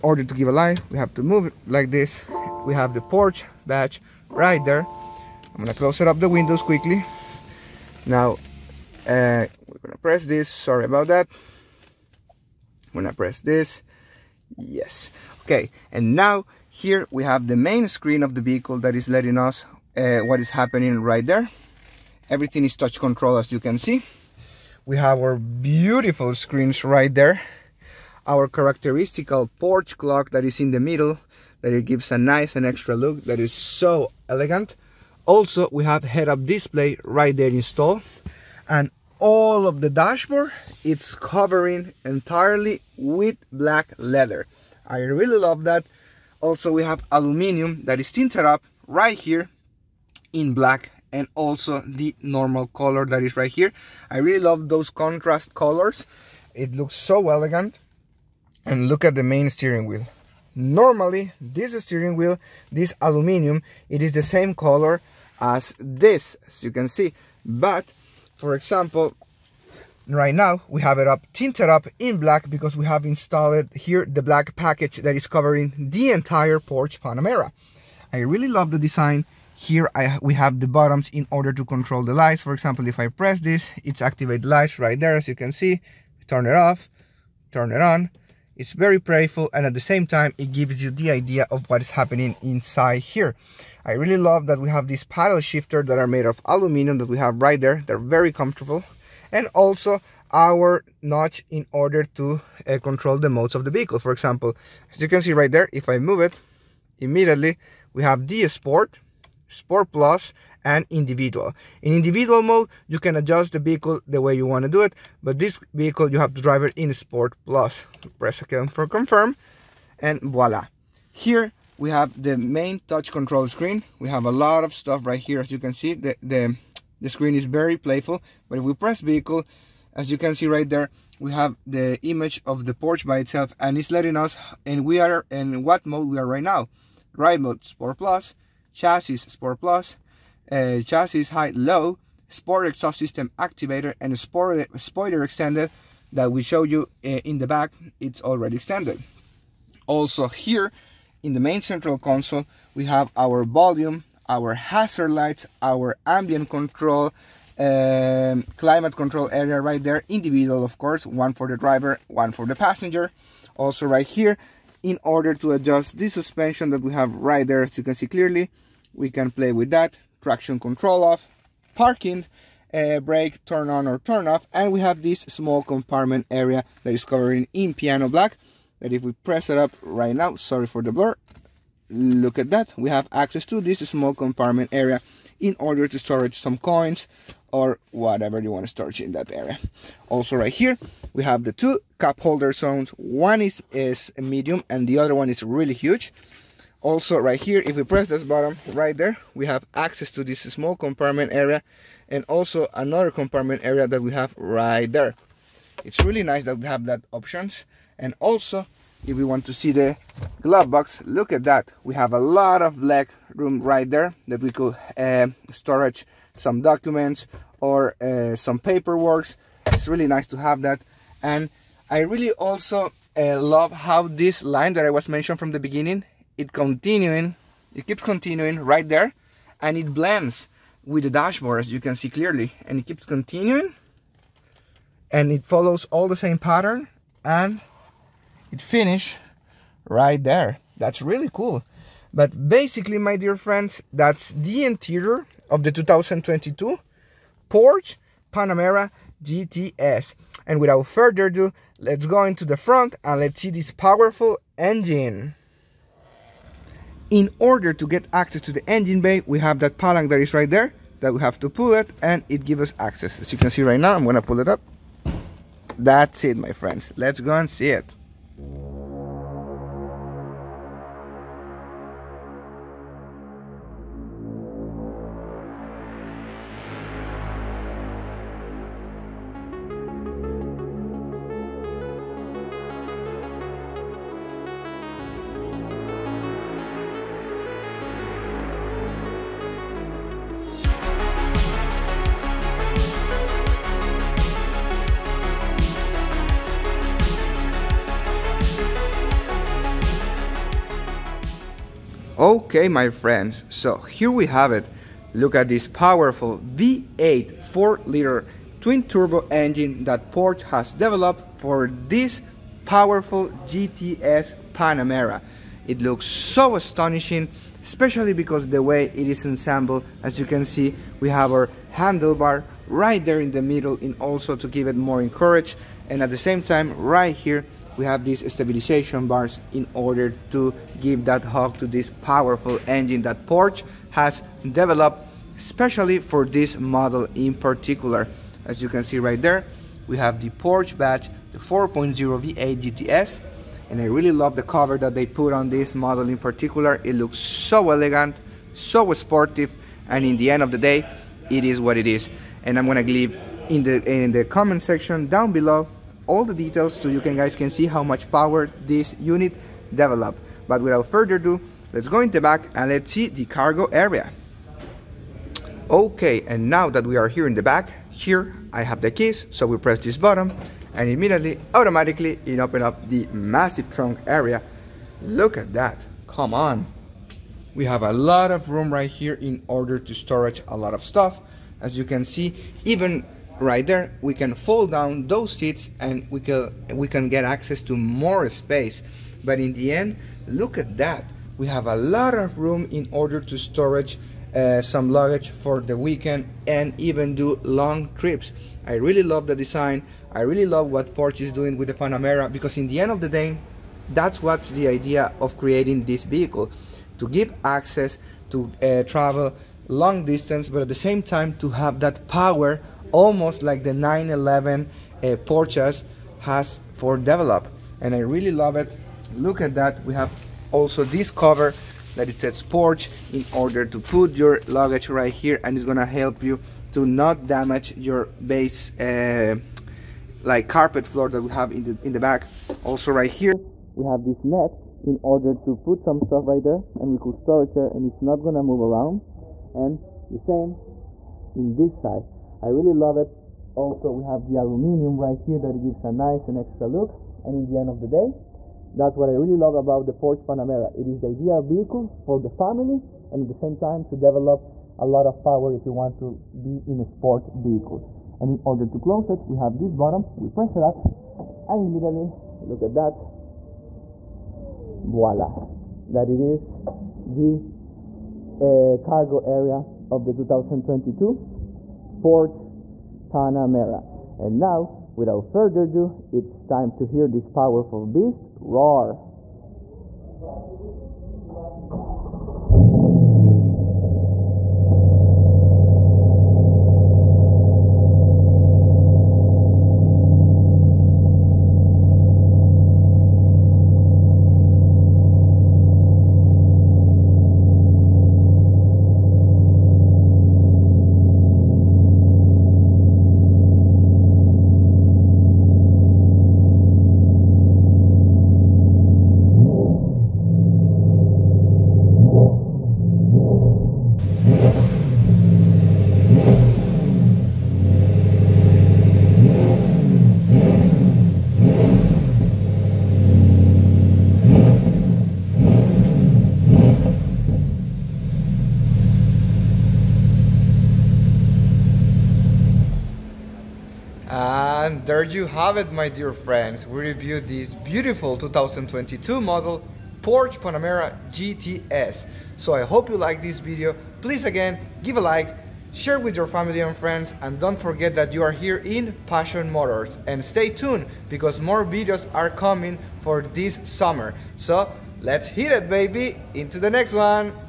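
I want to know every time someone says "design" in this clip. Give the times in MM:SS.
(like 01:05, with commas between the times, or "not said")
01:18, 06:39.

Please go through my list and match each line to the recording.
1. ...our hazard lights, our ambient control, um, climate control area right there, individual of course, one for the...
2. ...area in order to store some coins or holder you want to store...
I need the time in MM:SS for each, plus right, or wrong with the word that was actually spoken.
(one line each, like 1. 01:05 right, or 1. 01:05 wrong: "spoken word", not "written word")
1. 02:34 right
2. 03:04 wrong: "whatever", not "holder".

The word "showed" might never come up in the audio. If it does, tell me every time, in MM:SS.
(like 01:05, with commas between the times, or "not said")
02:26.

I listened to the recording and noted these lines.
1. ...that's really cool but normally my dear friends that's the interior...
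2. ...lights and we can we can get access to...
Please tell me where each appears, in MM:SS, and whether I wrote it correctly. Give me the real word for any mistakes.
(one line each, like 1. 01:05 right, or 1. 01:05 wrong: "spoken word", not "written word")
1. 04:00 wrong: "basically", not "normally"
2. 06:25 wrong: "seats", not "lights".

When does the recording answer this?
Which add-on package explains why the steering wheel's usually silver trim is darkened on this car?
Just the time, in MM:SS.
01:14.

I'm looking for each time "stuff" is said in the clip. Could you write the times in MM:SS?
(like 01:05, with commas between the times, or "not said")
02:04, 06:20, 07:15.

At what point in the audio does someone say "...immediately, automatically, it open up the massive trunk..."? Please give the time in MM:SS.
06:10.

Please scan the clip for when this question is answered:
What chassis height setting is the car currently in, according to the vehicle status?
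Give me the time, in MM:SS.
02:20.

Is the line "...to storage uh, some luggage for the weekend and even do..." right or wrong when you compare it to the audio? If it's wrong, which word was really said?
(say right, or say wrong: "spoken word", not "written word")
right.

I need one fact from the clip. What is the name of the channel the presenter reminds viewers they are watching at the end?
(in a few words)
Passion Motors.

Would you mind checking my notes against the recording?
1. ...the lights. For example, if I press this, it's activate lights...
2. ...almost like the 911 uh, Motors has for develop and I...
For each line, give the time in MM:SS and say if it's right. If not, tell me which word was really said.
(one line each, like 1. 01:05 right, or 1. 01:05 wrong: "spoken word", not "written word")
1. 01:22 right
2. 06:52 wrong: "Porsche", not "Motors".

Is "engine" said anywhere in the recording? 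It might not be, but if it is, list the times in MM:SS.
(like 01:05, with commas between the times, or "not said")
04:14, 04:18, 05:09, 05:32.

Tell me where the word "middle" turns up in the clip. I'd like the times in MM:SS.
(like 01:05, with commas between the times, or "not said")
00:30, 05:23.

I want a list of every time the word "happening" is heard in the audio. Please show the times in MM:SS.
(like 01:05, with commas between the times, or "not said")
00:20, 01:31.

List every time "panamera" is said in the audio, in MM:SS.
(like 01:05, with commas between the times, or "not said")
01:16, 04:08, 05:14, 06:41, 07:30, 07:53, 09:00.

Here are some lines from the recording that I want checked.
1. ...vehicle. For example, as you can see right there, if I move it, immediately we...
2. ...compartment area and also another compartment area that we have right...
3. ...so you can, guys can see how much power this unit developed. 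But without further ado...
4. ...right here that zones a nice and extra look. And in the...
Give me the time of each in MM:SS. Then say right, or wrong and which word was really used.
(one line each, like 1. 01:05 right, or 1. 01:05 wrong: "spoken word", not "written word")
1. 01:43 right
2. 03:20 right
3. 05:56 right
4. 07:25 wrong: "gives", not "zones".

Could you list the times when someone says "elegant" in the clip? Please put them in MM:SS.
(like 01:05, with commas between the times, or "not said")
00:34, 00:57, 05:47.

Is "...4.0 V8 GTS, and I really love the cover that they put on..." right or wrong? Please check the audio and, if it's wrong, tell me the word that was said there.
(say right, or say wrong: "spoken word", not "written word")
right.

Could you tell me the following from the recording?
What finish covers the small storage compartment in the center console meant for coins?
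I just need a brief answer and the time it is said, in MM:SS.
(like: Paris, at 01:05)
Piano black, at 02:57.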